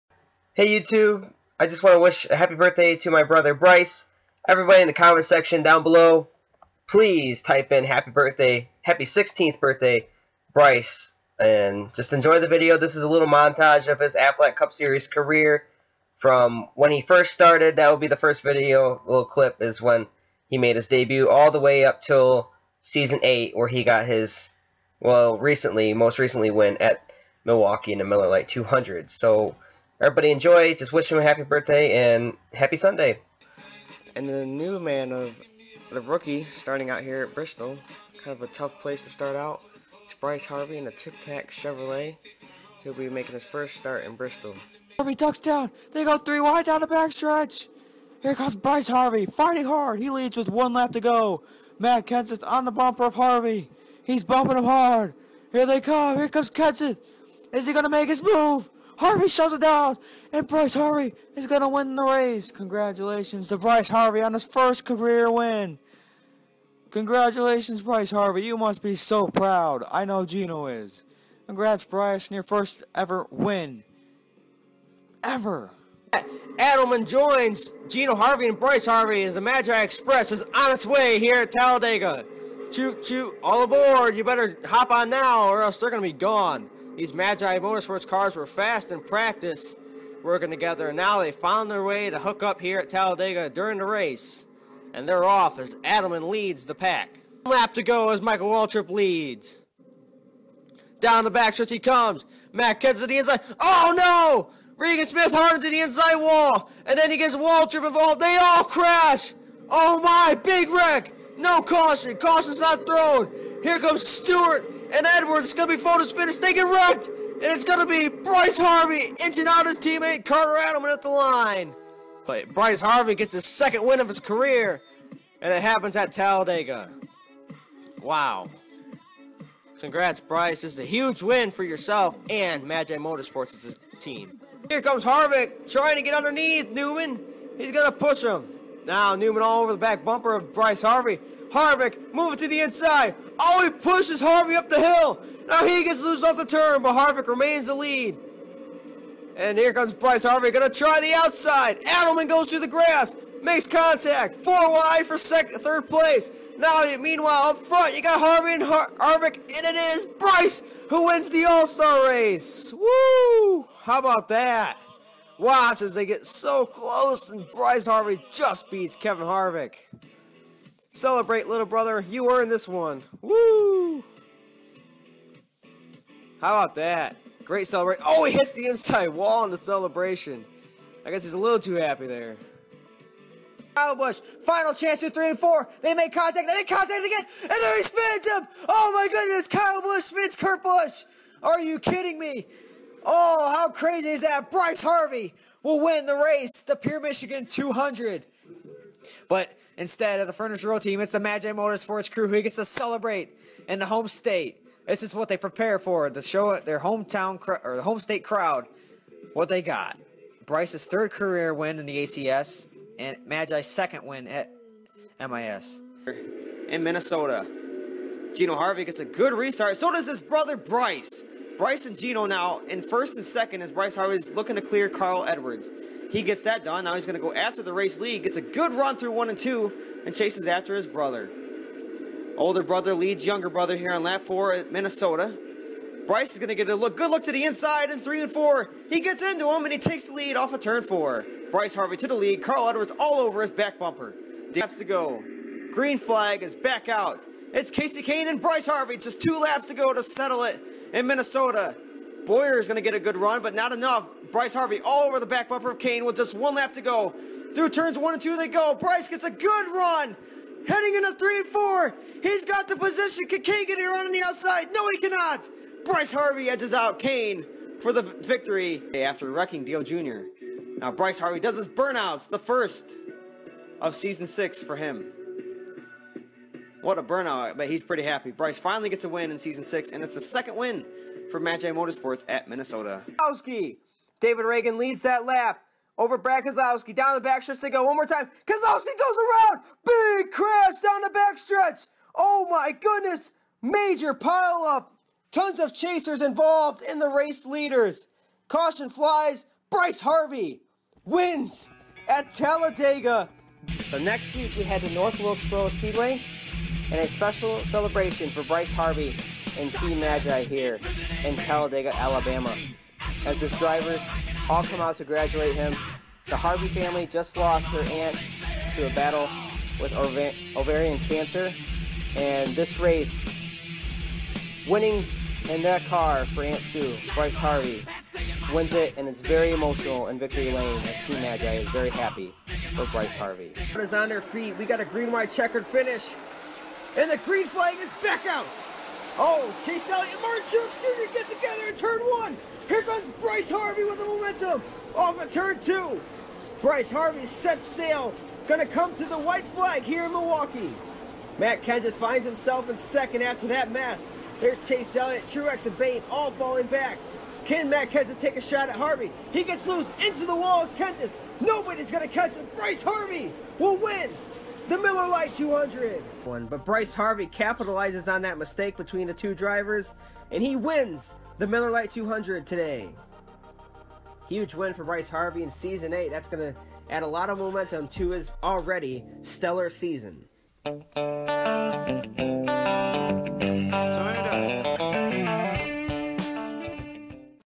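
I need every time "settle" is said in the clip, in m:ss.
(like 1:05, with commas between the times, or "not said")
4:10.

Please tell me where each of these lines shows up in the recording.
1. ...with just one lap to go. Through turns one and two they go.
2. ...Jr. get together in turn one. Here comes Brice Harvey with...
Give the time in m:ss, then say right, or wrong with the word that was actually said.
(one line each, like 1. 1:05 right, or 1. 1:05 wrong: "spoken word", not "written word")
1. 4:16 right
2. 5:40 right.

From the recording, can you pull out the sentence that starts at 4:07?
It's Kasey Kahne and Brice Harvey.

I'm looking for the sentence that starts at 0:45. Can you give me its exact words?
They go three wide down the backstretch.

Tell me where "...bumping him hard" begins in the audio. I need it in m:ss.
0:54.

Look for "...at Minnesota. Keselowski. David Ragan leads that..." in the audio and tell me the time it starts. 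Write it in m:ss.
4:42.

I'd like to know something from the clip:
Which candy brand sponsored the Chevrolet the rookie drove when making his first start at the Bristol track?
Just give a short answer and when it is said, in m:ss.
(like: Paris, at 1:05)
Tic Tac, at 0:40.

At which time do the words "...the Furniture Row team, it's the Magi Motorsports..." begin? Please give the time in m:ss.
3:20.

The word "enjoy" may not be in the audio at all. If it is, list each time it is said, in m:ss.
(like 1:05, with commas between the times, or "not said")
0:12, 0:30.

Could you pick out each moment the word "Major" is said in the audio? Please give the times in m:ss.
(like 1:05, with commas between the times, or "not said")
4:53.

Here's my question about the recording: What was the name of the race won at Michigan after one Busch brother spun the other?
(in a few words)
Pure Michigan 200.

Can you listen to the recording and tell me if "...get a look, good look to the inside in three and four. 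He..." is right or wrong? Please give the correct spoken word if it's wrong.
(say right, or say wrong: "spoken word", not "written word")
right.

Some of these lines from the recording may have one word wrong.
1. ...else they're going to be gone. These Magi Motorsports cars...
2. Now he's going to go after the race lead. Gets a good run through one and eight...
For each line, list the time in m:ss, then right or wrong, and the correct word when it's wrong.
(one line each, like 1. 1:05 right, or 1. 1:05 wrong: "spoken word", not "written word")
1. 1:25 right
2. 3:46 wrong: "two", not "eight".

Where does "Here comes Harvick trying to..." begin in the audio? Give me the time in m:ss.
2:14.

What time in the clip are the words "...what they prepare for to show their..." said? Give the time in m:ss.
3:25.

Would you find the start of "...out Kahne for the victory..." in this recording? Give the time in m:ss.
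4:26.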